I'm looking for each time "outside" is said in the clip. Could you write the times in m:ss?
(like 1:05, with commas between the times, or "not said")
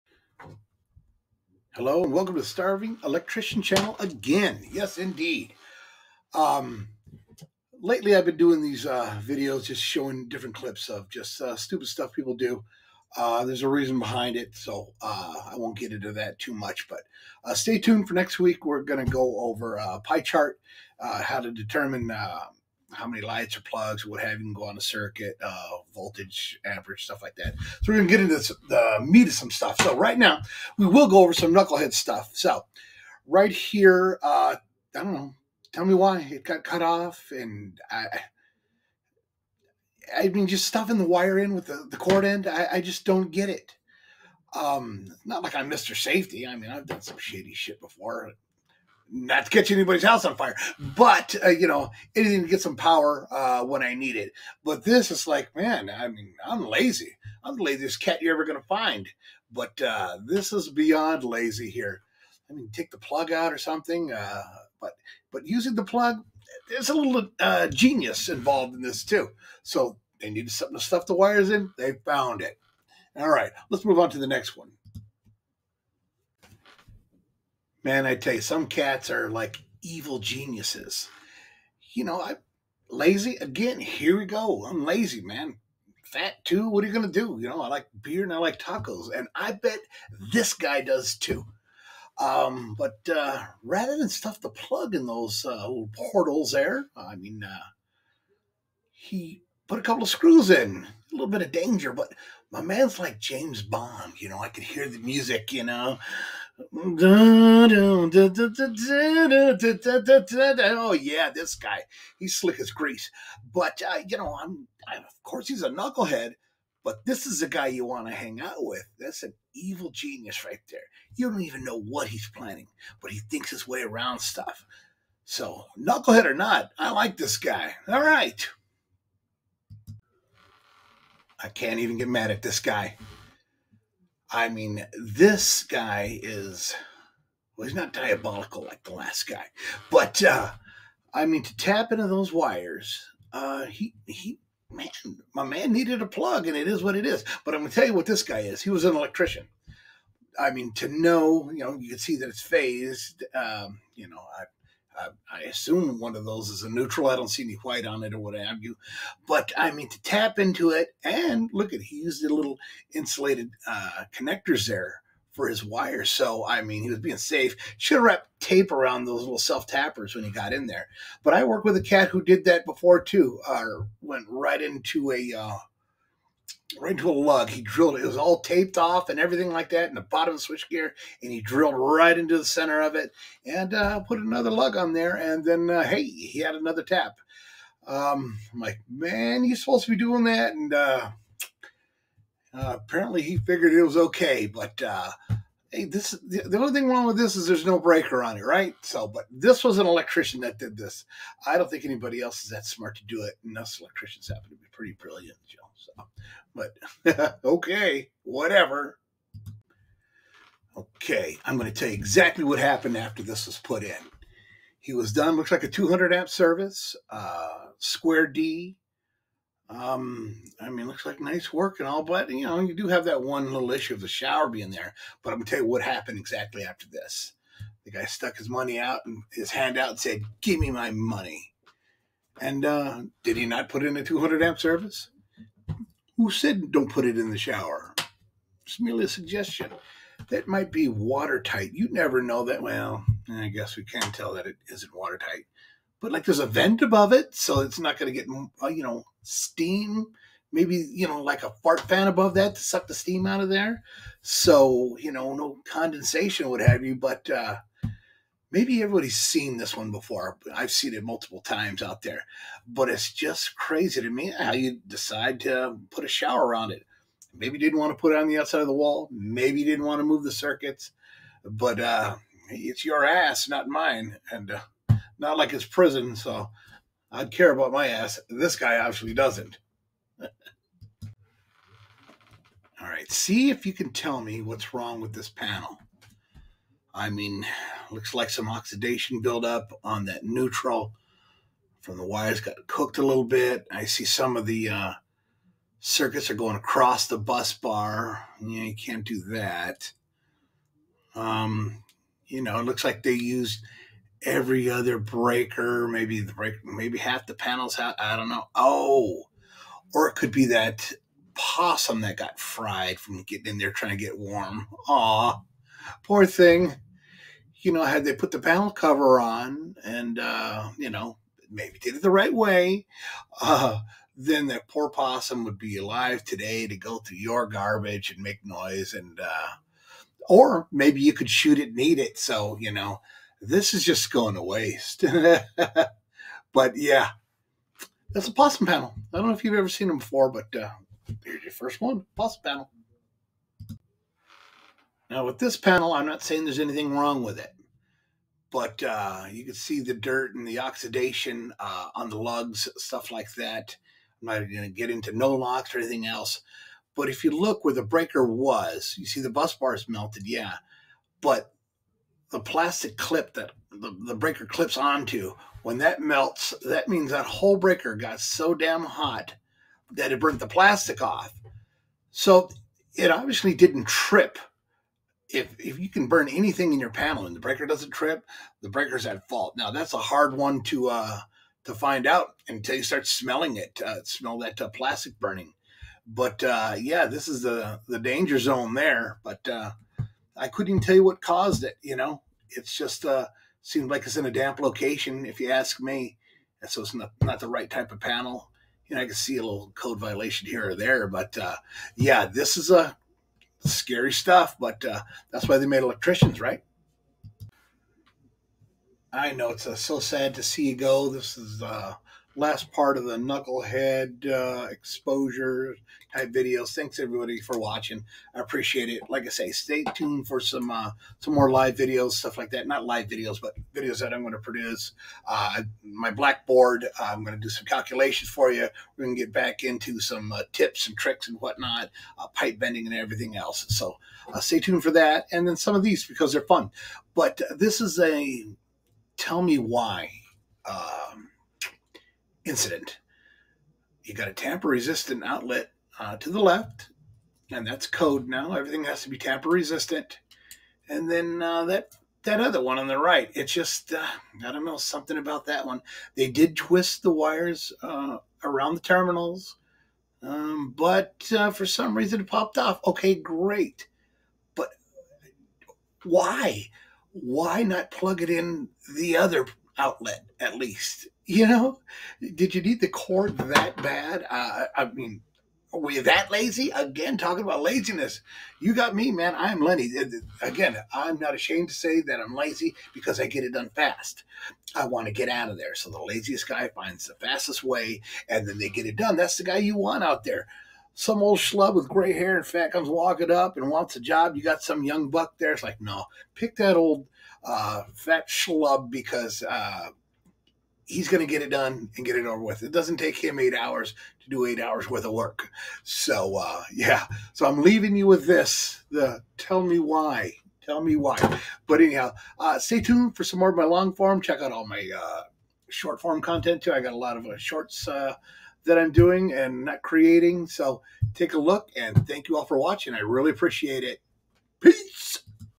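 4:28.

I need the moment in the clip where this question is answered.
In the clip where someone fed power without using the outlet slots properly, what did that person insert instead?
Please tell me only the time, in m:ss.
1:39.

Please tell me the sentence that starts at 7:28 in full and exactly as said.
Everything has to be tamper resistant.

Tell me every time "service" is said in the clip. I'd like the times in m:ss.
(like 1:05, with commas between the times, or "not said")
3:36, 3:54.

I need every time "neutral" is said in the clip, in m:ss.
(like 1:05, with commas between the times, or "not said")
2:36, 4:50.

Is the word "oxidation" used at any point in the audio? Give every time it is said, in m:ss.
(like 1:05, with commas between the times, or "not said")
4:48, 5:50.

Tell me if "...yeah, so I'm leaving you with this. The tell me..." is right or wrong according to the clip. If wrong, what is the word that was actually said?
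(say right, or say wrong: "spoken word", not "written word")
right.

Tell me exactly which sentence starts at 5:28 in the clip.
And, uh, or maybe you could shoot it and eat it.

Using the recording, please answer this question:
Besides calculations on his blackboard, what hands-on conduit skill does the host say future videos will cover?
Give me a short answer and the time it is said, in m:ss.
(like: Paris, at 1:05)
pipe bending, at 7:12.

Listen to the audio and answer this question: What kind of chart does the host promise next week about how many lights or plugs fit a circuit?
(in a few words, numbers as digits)
pie chart.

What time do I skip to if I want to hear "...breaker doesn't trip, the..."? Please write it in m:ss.
6:17.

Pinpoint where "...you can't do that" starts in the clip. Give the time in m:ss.
4:58.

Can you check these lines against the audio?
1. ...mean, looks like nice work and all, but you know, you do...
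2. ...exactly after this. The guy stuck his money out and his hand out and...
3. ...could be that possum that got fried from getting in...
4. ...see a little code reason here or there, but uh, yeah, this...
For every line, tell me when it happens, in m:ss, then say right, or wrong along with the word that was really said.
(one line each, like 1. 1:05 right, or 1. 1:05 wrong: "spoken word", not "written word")
1. 3:40 right
2. 3:46 right
3. 5:10 right
4. 6:39 wrong: "violation", not "reason".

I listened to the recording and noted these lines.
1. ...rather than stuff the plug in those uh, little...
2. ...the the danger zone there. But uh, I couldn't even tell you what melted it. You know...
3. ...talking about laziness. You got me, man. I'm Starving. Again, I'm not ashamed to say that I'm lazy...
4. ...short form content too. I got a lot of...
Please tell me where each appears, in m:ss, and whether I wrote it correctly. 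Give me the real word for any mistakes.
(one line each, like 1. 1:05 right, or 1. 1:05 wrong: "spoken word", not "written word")
1. 1:33 right
2. 6:27 wrong: "caused", not "melted"
3. 7:57 wrong: "Lenny", not "Starving"
4. 8:35 right.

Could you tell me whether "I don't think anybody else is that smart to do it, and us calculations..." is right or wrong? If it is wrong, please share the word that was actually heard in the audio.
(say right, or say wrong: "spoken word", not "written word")
wrong: "electricians", not "calculations".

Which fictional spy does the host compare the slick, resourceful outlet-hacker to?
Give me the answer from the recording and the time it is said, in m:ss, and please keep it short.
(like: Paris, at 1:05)
James Bond, at 1:43.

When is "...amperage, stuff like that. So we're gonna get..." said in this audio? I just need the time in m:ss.
0:26.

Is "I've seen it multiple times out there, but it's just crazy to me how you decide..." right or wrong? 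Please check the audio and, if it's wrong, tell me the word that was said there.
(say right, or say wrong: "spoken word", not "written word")
right.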